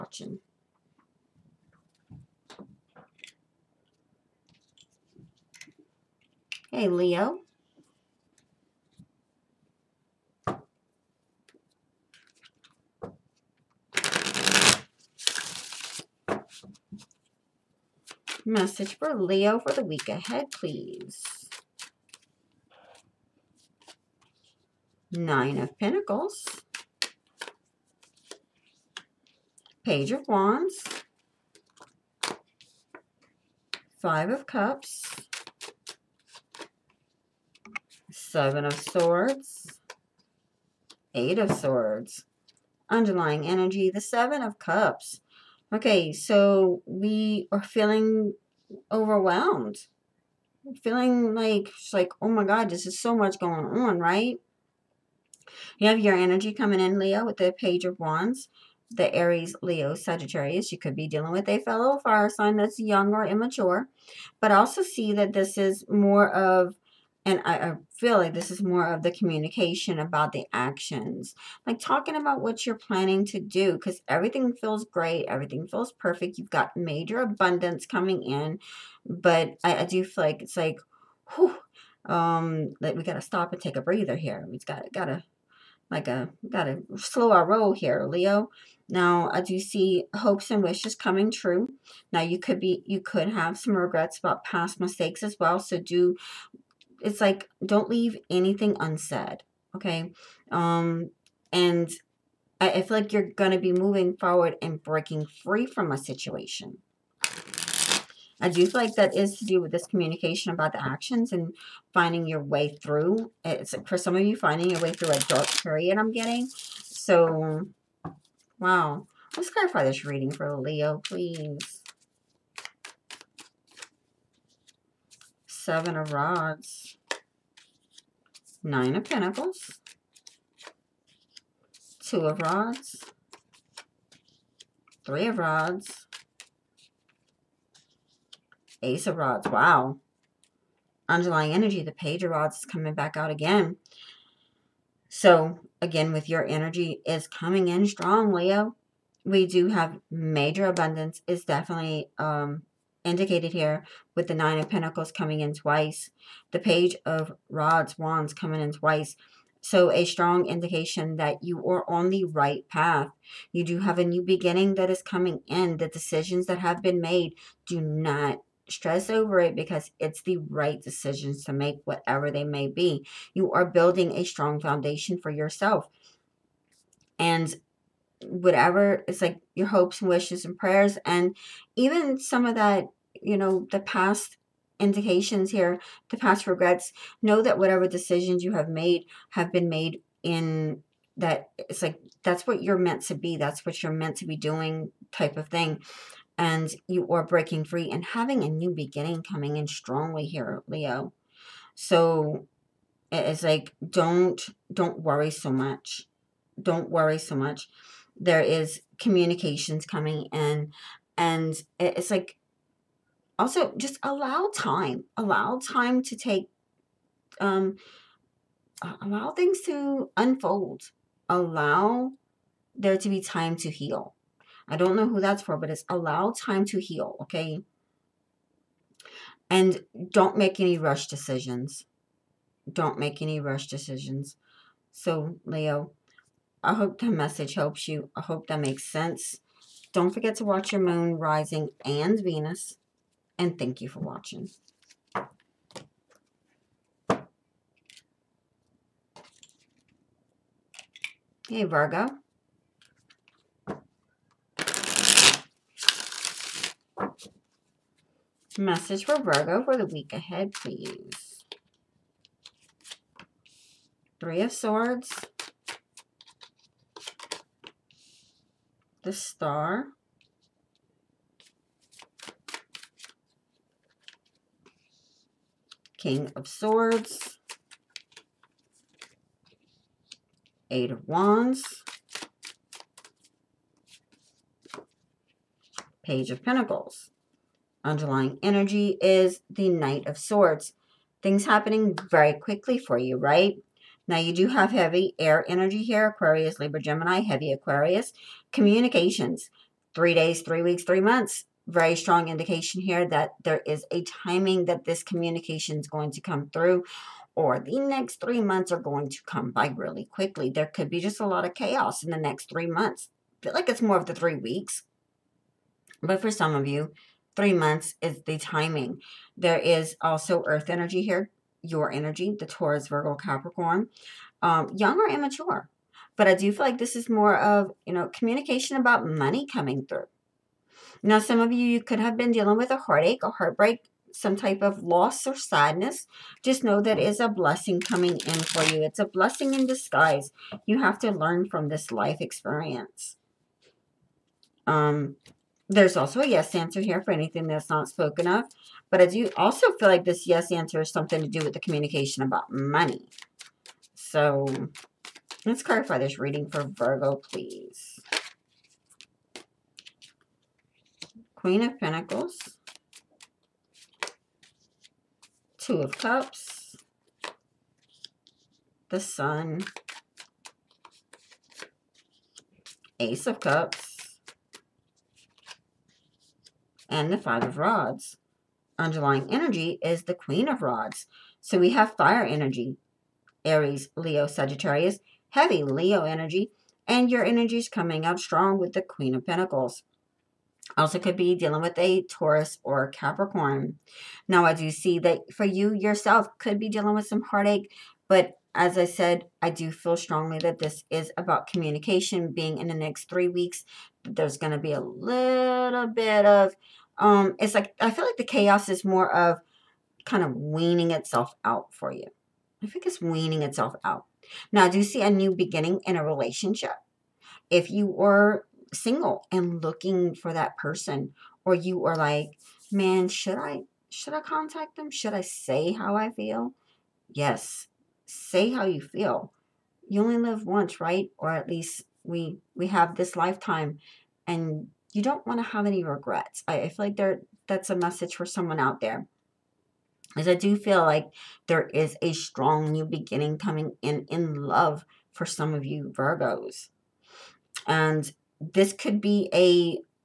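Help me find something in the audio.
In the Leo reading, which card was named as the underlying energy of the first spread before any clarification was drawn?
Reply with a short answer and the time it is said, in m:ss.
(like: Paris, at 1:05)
Seven of Cups, at 0:43.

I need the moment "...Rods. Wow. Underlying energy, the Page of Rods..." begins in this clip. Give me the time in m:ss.
2:19.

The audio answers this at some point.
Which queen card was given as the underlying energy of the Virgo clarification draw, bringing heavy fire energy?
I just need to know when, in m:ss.
6:20.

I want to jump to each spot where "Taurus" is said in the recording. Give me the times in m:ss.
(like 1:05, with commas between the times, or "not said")
5:22, 6:32.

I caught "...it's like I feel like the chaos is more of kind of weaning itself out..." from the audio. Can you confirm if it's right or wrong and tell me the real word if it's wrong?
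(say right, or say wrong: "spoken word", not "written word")
right.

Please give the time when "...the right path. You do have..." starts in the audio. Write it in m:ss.
2:42.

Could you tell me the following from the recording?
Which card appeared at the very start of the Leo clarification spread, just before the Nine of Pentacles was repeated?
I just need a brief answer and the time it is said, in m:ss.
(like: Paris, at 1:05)
Seven of Rods, at 2:05.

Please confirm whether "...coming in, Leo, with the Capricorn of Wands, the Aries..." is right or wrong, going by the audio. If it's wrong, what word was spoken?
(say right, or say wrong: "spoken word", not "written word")
wrong: "Page", not "Capricorn".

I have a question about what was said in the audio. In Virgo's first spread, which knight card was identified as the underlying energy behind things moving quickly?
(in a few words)
Knight of Swords.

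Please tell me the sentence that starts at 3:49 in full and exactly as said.
And don't make any rush decisions.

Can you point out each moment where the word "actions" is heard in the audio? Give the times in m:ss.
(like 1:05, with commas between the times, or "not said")
1:10, 1:50.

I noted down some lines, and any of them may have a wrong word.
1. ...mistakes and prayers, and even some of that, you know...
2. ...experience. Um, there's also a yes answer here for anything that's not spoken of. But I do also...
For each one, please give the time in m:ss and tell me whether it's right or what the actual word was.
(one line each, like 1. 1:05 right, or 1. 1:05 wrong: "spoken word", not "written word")
1. 3:00 wrong: "wishes", not "mistakes"
2. 5:42 right.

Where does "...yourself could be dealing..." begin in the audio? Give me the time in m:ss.
6:35.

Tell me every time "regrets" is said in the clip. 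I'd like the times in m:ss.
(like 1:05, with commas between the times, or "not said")
1:33, 3:06, 7:15.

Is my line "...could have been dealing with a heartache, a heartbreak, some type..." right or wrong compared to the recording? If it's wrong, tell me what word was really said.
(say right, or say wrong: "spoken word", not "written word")
right.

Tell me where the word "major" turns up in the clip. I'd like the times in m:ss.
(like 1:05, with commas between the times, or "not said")
1:16, 2:30.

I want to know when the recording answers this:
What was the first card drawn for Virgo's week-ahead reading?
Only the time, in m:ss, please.
4:24.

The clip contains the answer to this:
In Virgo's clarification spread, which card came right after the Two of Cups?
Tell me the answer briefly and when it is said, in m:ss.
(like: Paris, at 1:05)
The Sun, at 6:08.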